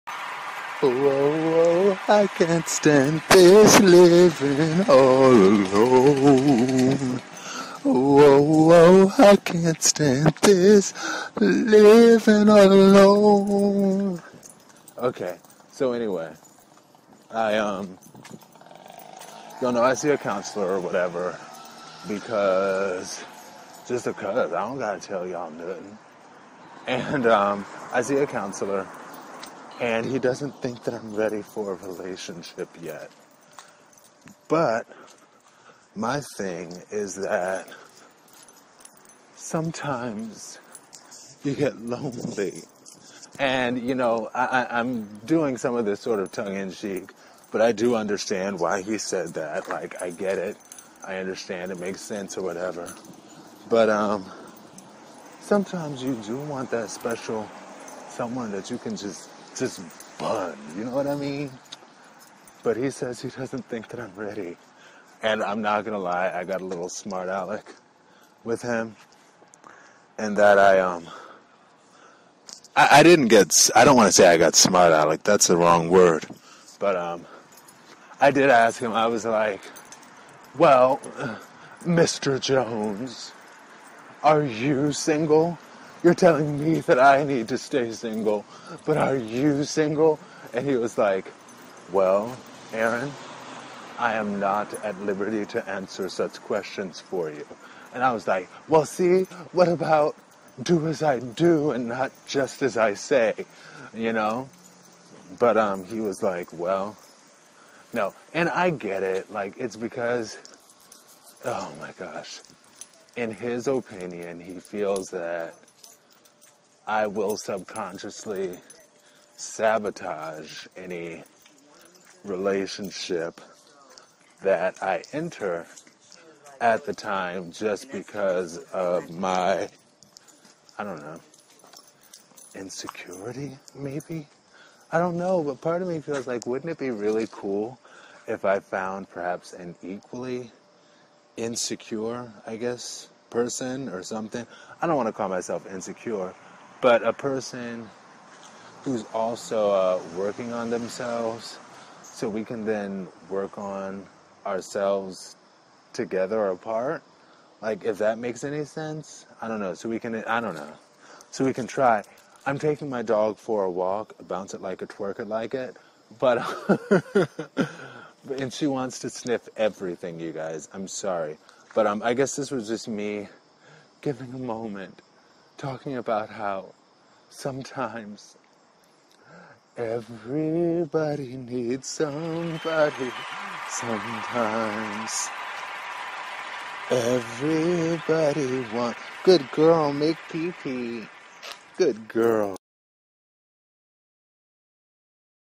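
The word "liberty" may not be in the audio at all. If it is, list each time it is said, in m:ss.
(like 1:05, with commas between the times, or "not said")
1:35.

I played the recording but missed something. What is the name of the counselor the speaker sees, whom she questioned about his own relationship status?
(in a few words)
Mr. Jones.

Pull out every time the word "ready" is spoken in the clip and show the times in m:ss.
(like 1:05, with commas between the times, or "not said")
0:31, 1:04.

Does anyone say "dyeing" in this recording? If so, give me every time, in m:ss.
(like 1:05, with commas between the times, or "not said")
not said.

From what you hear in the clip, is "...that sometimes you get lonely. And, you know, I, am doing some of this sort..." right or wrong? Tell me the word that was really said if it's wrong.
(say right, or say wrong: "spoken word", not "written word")
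right.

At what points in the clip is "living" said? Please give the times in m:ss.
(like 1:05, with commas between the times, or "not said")
0:03, 0:11.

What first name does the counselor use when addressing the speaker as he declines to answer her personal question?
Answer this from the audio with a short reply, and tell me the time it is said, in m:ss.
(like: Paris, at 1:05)
Aaron, at 1:32.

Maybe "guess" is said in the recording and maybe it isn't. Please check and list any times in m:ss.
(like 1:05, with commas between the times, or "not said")
2:22, 2:52.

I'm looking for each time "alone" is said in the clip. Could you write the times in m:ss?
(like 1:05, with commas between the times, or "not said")
0:05, 0:12.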